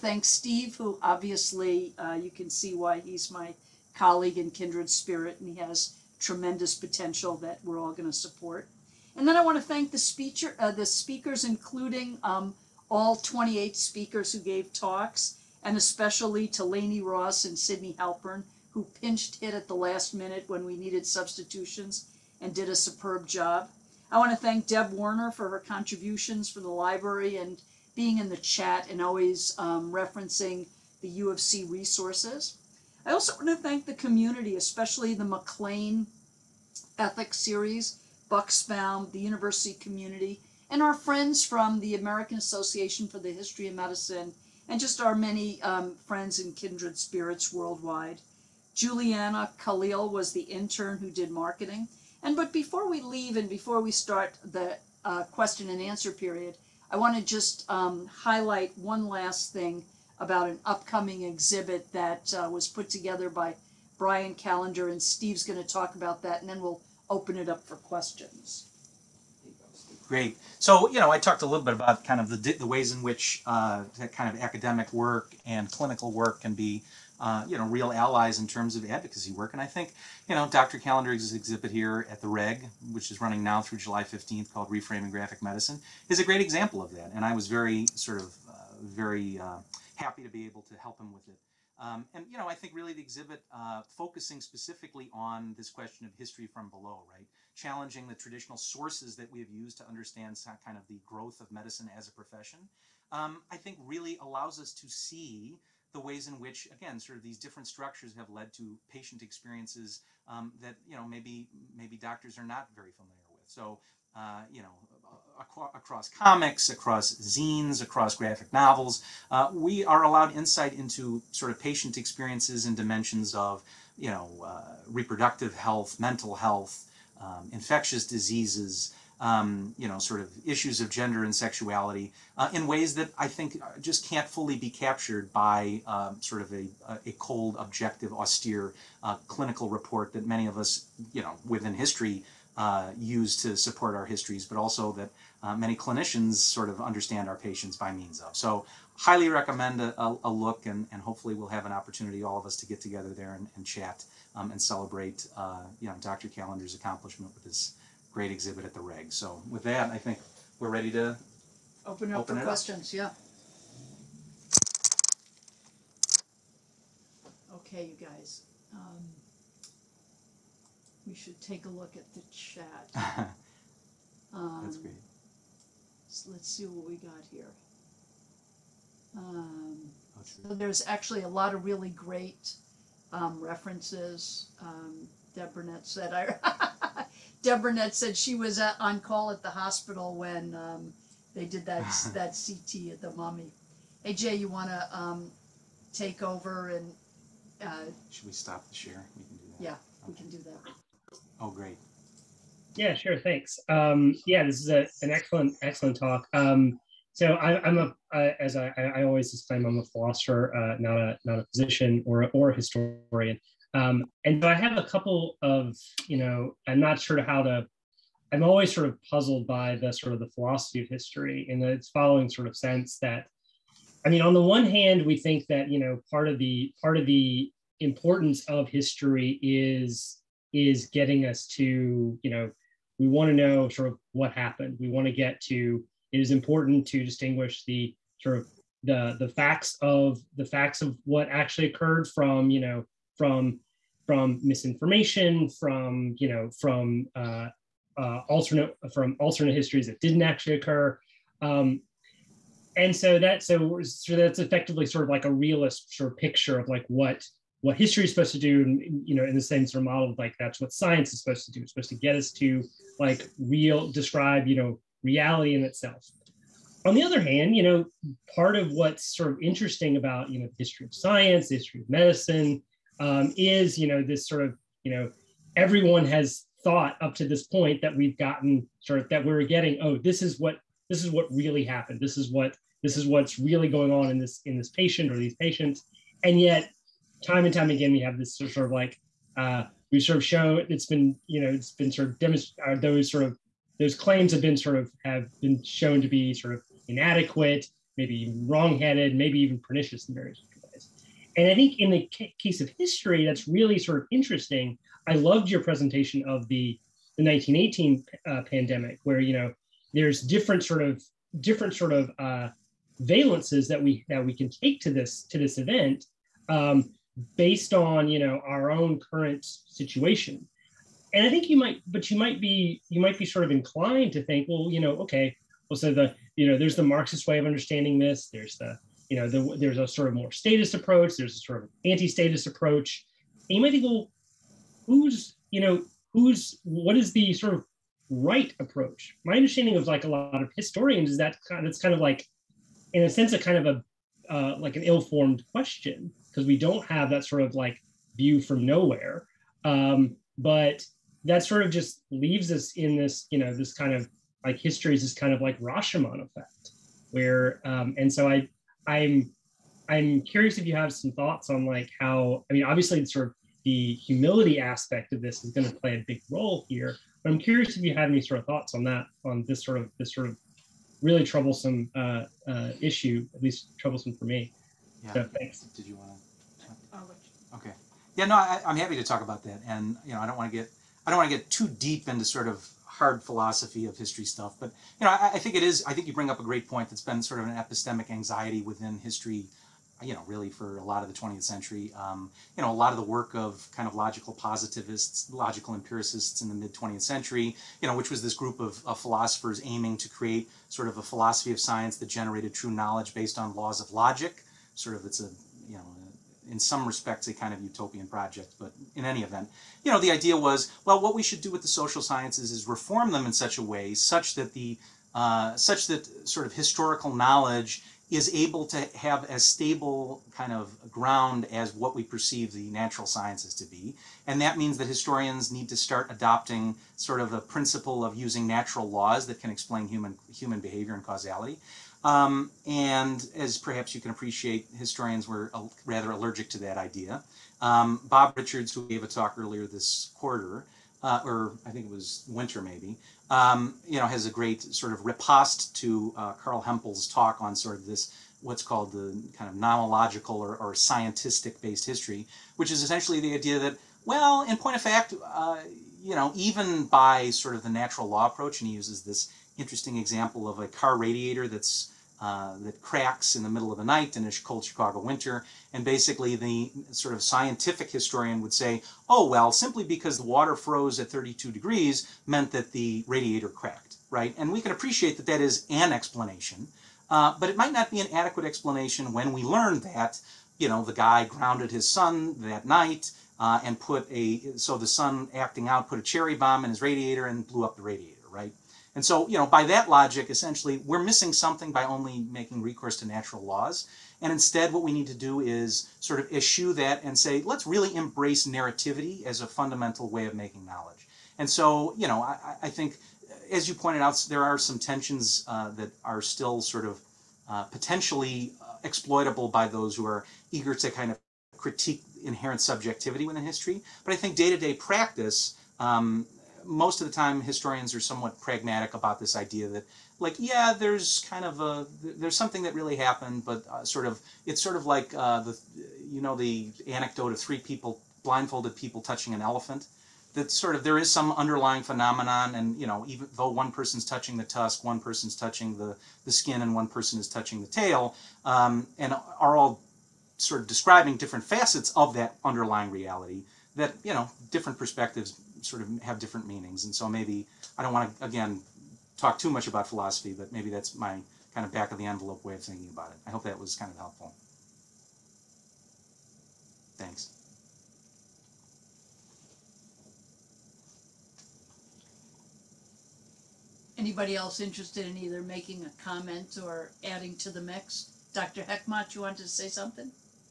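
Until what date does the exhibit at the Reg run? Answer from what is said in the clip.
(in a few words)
July 15th.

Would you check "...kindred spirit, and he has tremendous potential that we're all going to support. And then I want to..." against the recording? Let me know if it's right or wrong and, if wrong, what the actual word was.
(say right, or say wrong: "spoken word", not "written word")
right.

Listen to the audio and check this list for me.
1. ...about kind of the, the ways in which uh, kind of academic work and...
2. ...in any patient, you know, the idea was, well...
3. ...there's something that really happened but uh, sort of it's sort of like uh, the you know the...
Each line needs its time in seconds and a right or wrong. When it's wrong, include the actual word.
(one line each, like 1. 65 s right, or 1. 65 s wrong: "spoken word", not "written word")
1. 71 s right
2. 408 s wrong: "event", not "patient"
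3. 522 s right.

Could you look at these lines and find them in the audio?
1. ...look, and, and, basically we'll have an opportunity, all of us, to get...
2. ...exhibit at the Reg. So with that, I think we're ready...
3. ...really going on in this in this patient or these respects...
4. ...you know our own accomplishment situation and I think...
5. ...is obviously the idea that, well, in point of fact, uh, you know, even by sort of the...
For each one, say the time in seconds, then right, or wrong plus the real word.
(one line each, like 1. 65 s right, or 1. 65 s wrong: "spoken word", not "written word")
1. 150 s wrong: "hopefully", not "basically"
2. 158 s right
3. 283 s wrong: "patients", not "respects"
4. 318 s wrong: "current", not "accomplishment"
5. 452 s wrong: "essentially", not "obviously".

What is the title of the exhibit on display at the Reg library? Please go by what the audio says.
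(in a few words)
Reframing Graphic Medicine.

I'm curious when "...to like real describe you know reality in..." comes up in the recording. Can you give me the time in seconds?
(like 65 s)
262 s.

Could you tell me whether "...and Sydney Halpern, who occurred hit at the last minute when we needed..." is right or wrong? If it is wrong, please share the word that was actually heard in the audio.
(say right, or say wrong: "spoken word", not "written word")
wrong: "pinched", not "occurred".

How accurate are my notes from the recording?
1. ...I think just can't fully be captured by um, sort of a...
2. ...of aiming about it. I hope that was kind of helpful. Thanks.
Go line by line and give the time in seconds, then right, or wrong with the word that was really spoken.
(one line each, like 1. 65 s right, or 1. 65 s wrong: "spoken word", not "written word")
1. 133 s right
2. 552 s wrong: "thinking", not "aiming".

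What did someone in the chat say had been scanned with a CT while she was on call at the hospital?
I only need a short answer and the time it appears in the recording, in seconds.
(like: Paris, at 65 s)
the Mummy, at 193 s.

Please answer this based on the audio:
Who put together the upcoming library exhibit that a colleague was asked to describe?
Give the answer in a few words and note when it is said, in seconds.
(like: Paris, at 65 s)
Brian Callender, at 63 s.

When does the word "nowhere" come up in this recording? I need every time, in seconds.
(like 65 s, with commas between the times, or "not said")
348 s.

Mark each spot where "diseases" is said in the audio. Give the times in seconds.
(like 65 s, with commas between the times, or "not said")
128 s.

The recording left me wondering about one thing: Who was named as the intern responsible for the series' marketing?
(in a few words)
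Juliana Khalil.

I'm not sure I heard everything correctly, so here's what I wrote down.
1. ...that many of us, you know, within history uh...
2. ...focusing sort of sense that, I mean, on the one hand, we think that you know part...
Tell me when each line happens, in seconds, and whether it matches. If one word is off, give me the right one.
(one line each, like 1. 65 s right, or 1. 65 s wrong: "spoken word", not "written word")
1. 140 s right
2. 221 s wrong: "following", not "focusing".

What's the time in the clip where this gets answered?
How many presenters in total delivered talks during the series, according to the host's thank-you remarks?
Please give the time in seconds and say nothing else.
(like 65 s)
13 s.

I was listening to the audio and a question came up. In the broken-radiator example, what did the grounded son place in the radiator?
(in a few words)
a cherry bomb.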